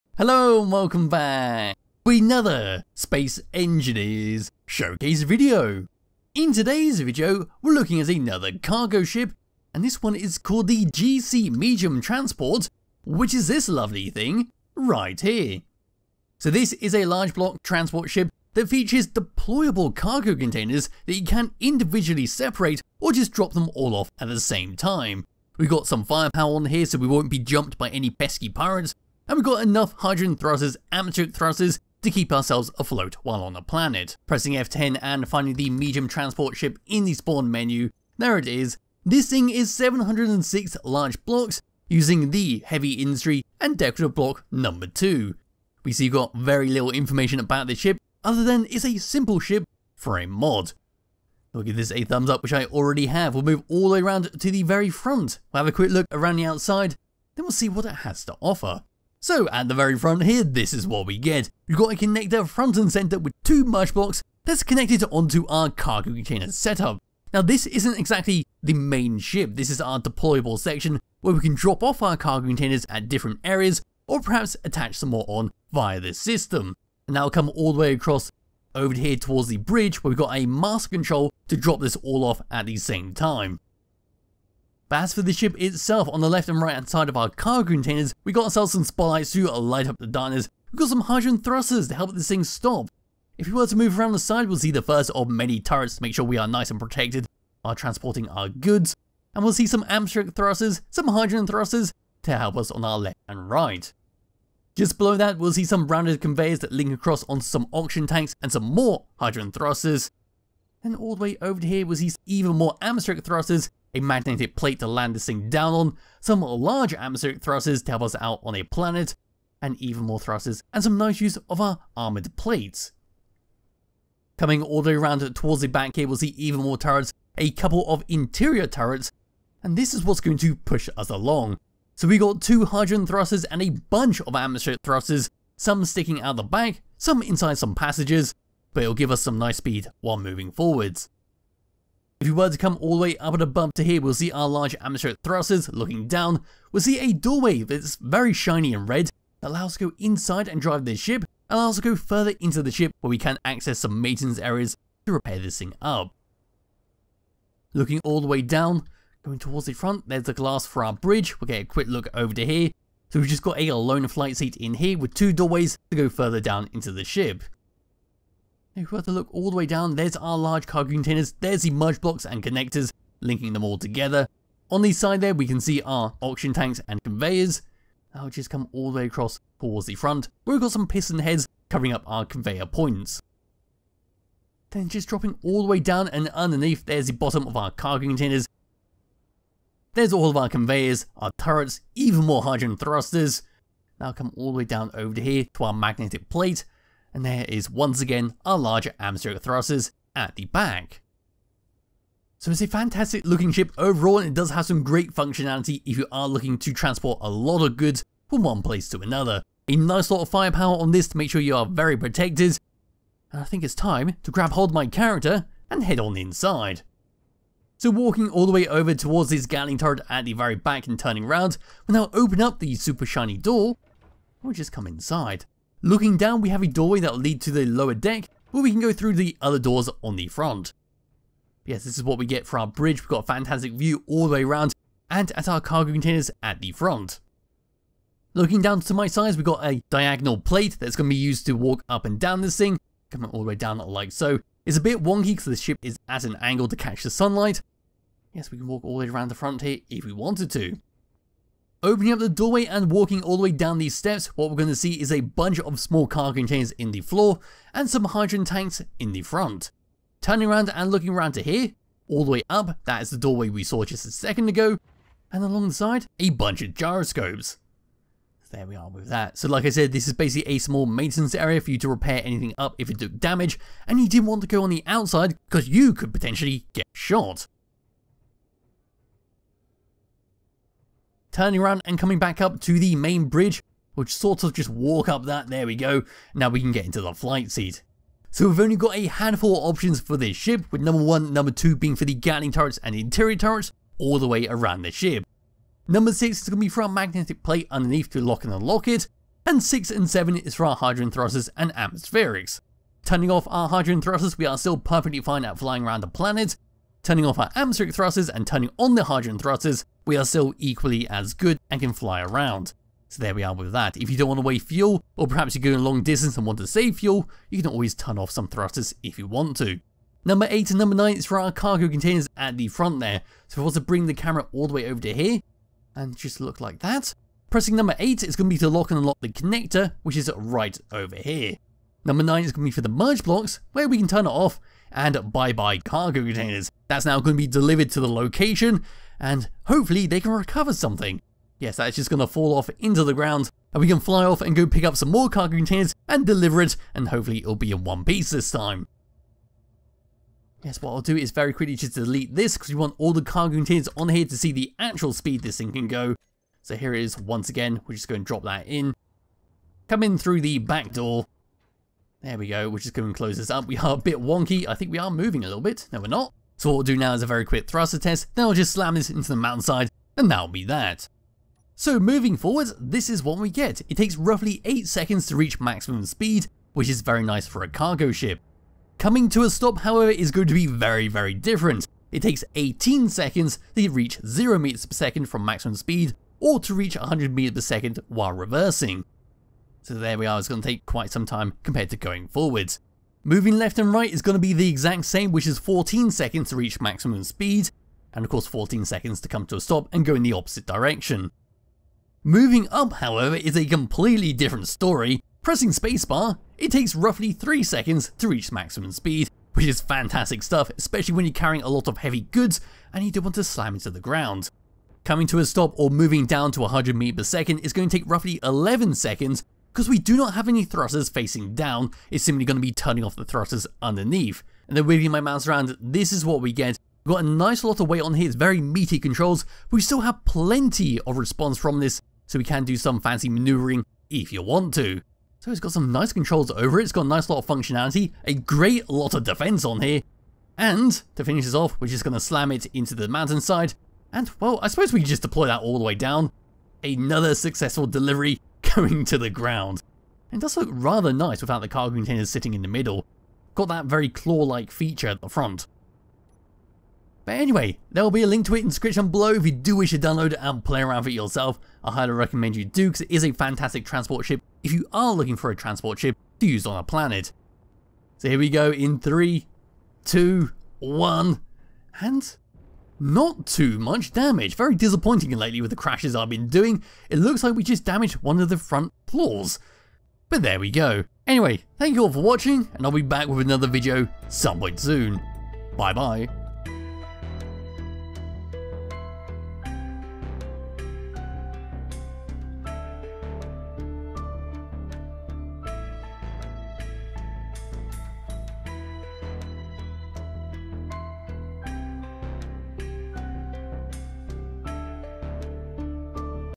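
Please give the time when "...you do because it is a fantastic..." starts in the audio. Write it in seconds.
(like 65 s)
462 s.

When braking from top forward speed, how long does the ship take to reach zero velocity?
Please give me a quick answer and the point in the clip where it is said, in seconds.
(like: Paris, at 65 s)
18 seconds, at 382 s.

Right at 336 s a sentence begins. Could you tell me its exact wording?
That's now going to be delivered to the location, and hopefully they can recover something.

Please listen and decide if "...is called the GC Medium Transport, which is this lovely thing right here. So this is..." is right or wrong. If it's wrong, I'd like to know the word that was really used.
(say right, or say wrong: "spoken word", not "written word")
right.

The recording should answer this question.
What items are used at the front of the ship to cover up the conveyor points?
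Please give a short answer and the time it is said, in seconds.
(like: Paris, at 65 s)
piston heads, at 180 s.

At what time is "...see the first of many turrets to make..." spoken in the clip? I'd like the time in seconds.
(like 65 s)
94 s.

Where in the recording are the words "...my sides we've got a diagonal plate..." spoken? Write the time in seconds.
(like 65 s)
238 s.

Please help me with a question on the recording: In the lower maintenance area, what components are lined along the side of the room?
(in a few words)
gyroscopes.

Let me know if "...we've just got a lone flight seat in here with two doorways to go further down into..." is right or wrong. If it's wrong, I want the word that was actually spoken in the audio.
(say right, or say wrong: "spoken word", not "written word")
right.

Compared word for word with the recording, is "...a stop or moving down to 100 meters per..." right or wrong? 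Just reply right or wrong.
right.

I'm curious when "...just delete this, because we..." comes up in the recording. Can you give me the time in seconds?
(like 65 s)
351 s.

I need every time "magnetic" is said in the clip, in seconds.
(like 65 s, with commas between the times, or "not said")
113 s, 195 s, 296 s.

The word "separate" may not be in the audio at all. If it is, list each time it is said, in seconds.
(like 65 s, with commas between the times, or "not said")
22 s.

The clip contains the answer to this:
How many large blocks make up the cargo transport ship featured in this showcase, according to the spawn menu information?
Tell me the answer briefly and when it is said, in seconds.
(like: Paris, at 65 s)
706, at 39 s.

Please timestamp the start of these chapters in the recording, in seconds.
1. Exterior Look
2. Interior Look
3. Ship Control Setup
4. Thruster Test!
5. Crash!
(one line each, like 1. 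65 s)
1. 59 s
2. 221 s
3. 286 s
4. 368 s
5. 460 s.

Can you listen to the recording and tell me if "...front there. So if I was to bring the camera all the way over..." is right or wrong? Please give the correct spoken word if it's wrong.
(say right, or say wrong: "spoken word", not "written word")
right.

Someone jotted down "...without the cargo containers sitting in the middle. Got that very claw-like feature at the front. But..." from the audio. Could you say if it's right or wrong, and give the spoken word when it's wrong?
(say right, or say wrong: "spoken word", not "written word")
right.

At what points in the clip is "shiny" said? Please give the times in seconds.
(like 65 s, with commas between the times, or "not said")
148 s, 223 s.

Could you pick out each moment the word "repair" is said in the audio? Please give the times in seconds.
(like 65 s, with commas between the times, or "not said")
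155 s, 271 s.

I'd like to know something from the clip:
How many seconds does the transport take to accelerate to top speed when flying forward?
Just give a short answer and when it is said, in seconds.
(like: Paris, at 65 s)
8, at 374 s.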